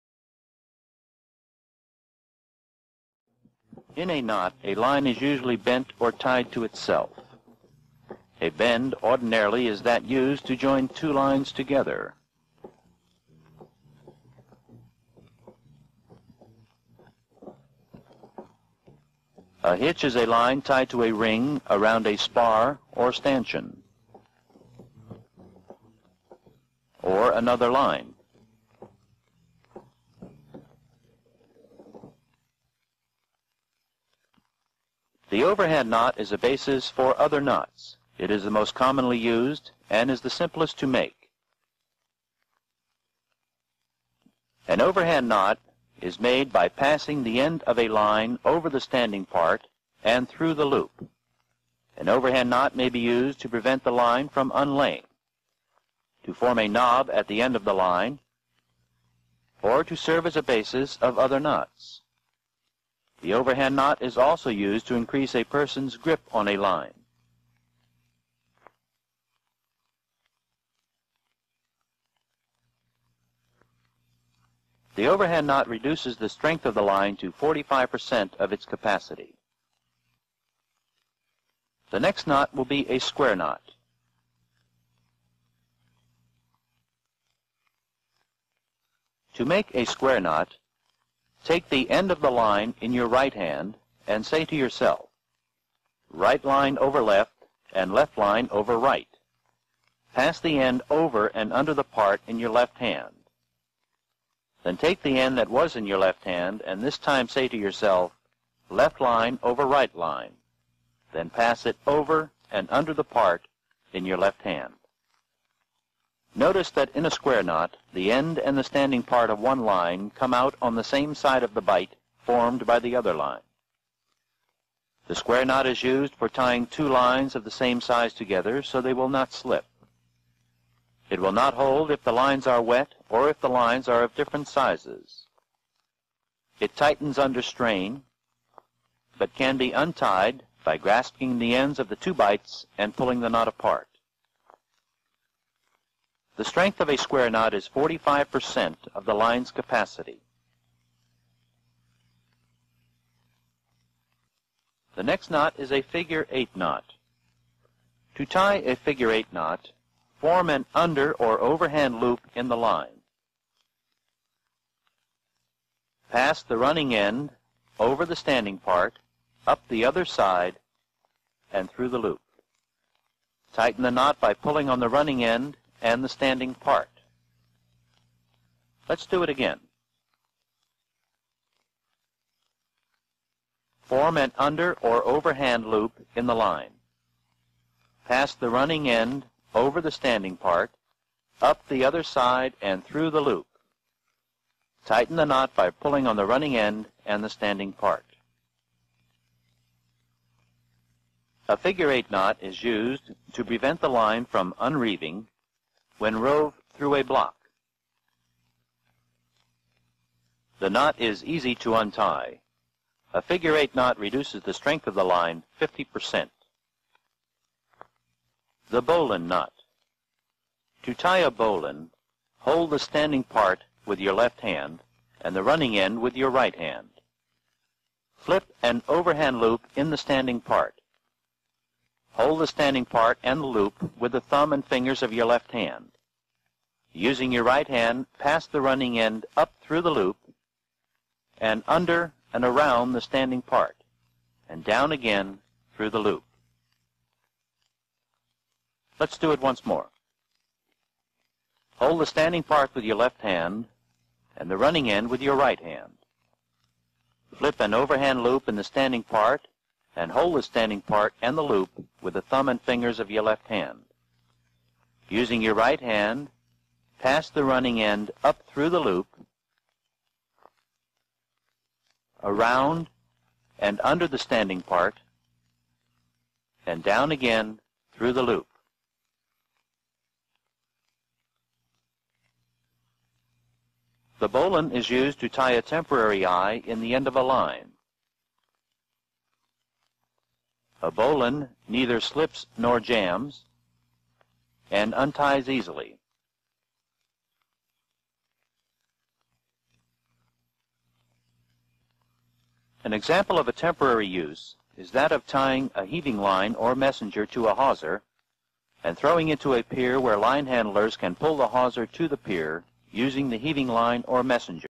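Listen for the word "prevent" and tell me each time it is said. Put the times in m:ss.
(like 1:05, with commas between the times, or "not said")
0:53, 3:23.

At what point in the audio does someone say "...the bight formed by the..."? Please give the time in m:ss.
2:01.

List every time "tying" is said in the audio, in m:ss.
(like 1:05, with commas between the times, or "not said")
2:06, 5:05.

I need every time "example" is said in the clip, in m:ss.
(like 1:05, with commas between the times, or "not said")
5:02.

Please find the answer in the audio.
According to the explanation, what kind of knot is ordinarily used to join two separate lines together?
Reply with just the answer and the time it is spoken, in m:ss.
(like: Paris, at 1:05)
bend, at 0:08.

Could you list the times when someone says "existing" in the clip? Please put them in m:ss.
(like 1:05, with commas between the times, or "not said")
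not said.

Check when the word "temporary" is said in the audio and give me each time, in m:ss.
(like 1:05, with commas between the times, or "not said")
4:45, 5:03.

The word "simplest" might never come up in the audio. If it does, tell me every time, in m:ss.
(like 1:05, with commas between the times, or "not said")
0:40.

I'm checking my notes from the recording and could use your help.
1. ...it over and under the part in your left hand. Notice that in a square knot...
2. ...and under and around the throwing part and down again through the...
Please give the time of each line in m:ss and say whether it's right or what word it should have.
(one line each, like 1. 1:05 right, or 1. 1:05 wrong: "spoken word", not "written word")
1. 1:51 right
2. 4:01 wrong: "standing", not "throwing".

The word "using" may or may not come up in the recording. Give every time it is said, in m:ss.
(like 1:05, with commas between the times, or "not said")
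3:56, 4:25, 5:12.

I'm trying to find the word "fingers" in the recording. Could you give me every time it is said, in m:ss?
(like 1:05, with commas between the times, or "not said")
3:54, 4:22.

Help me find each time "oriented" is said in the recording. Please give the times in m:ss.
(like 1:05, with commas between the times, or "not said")
not said.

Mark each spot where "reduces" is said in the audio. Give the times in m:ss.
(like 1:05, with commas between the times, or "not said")
1:15, 3:33.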